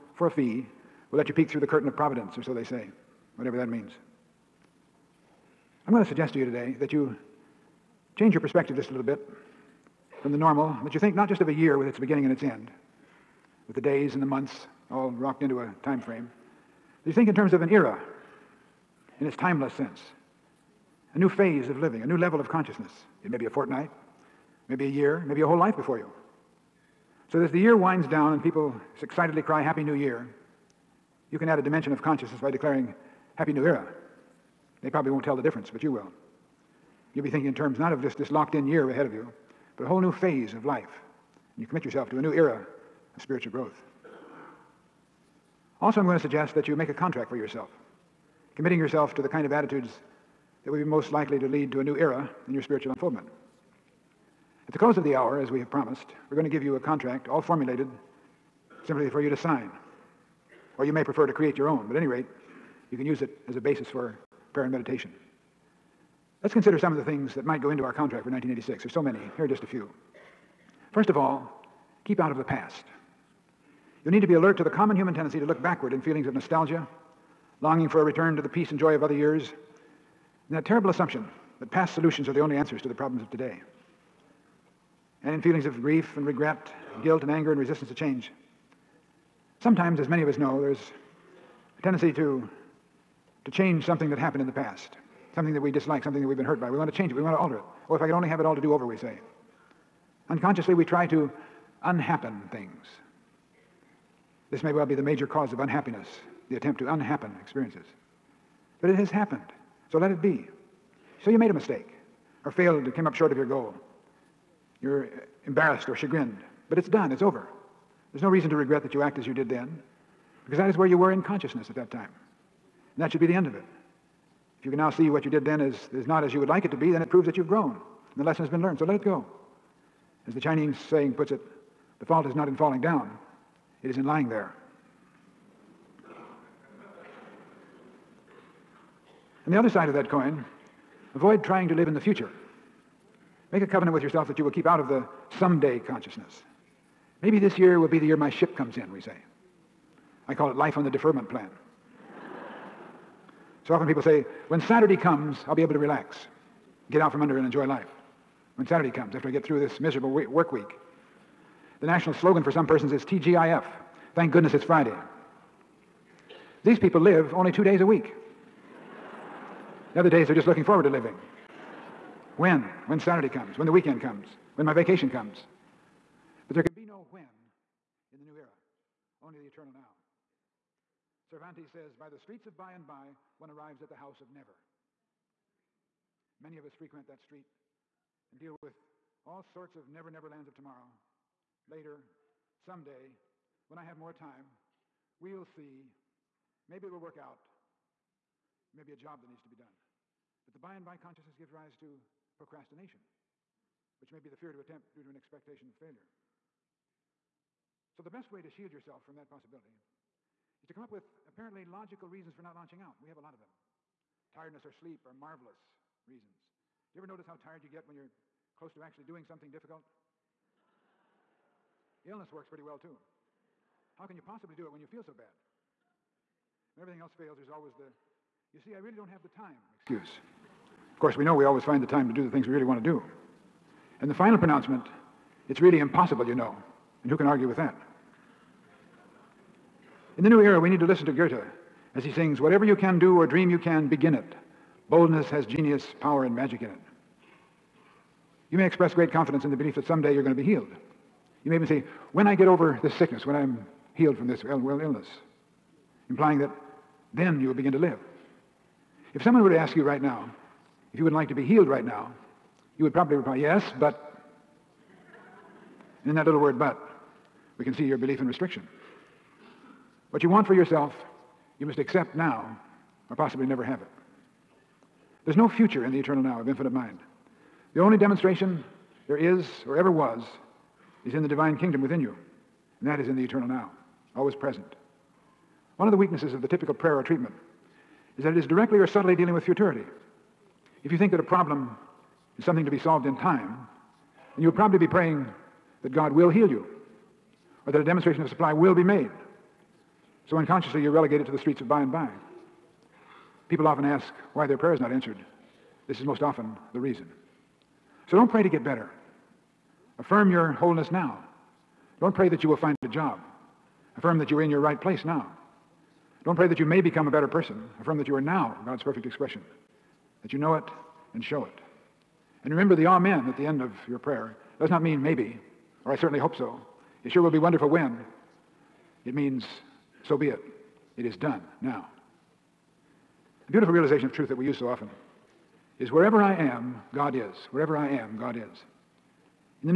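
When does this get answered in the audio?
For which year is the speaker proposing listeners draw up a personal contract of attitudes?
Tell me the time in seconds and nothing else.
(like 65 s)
68 s.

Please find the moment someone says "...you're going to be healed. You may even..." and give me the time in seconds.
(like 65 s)
250 s.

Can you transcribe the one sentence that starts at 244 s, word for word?
Boldness has genius, power, and magic in it.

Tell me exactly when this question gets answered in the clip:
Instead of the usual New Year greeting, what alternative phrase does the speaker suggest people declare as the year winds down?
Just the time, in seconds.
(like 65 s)
33 s.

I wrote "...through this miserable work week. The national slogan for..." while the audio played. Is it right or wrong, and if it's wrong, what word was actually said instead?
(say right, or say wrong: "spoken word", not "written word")
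right.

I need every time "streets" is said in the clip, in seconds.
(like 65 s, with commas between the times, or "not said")
182 s, 187 s, 301 s.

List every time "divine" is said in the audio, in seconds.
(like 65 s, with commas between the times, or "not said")
281 s.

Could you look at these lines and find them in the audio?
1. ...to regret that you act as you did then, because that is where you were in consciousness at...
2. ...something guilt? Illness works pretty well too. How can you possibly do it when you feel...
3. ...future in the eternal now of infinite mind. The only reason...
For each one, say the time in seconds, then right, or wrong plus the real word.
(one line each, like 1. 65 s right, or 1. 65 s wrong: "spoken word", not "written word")
1. 118 s right
2. 219 s wrong: "difficult", not "guilt"
3. 275 s wrong: "demonstration", not "reason".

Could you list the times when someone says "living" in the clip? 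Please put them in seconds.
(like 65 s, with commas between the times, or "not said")
21 s, 170 s.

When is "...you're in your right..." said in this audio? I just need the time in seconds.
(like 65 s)
314 s.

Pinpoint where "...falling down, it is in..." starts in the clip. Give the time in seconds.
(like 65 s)
132 s.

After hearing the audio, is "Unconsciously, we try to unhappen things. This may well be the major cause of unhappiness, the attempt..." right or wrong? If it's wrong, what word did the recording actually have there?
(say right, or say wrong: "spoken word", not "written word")
right.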